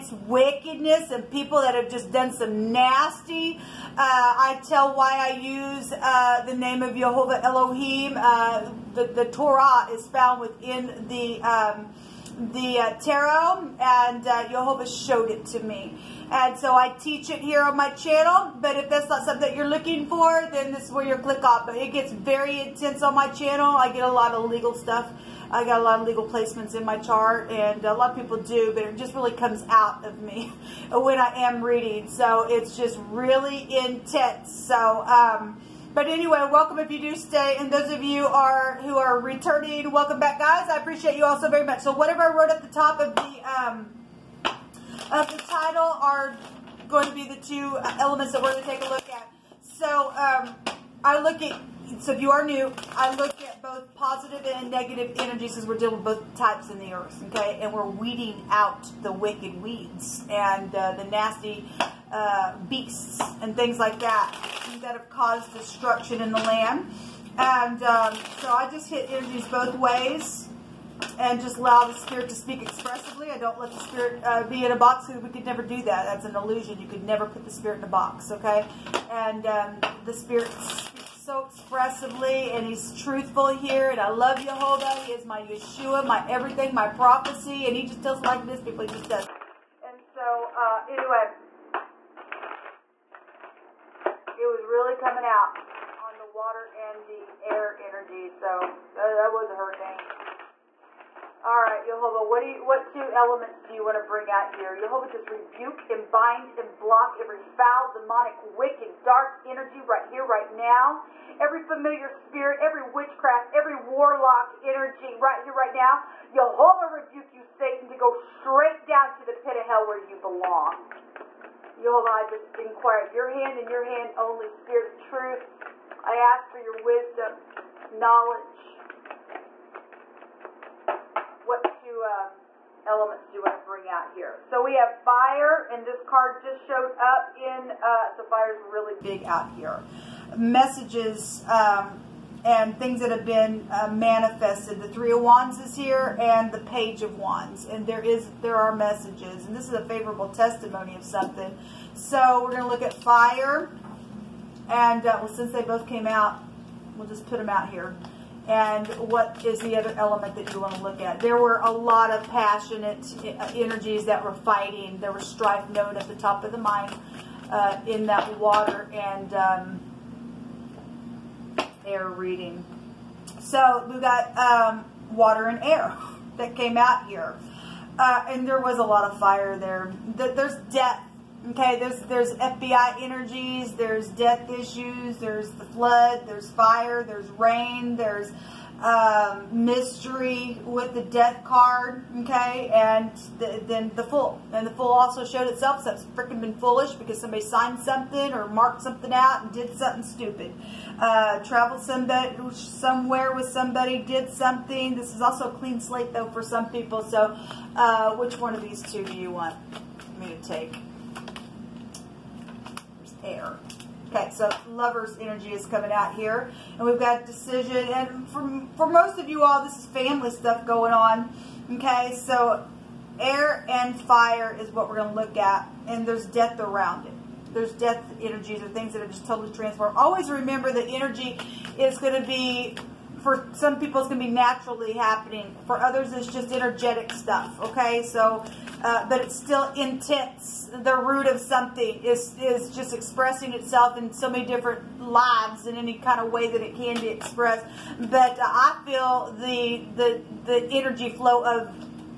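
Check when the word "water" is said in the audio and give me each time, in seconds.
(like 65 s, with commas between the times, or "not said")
96 s, 168 s, 175 s.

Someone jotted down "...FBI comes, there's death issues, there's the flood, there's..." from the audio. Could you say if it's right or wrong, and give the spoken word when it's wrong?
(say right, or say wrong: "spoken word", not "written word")
wrong: "energies", not "comes".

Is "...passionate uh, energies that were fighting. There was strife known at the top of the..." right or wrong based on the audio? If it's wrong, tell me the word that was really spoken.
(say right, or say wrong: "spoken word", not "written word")
right.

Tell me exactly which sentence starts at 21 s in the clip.
But it gets very intense on my channel.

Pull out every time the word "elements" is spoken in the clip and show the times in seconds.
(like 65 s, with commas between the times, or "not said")
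47 s, 103 s, 132 s, 159 s.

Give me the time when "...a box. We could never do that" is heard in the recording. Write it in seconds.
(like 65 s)
74 s.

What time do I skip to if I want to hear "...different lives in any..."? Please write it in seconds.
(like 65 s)
244 s.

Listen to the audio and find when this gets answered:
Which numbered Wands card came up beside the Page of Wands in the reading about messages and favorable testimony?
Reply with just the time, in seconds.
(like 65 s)
144 s.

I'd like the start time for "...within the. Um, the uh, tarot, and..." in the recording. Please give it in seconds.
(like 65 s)
10 s.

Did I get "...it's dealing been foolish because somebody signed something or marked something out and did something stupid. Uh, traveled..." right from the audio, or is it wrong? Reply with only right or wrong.
wrong.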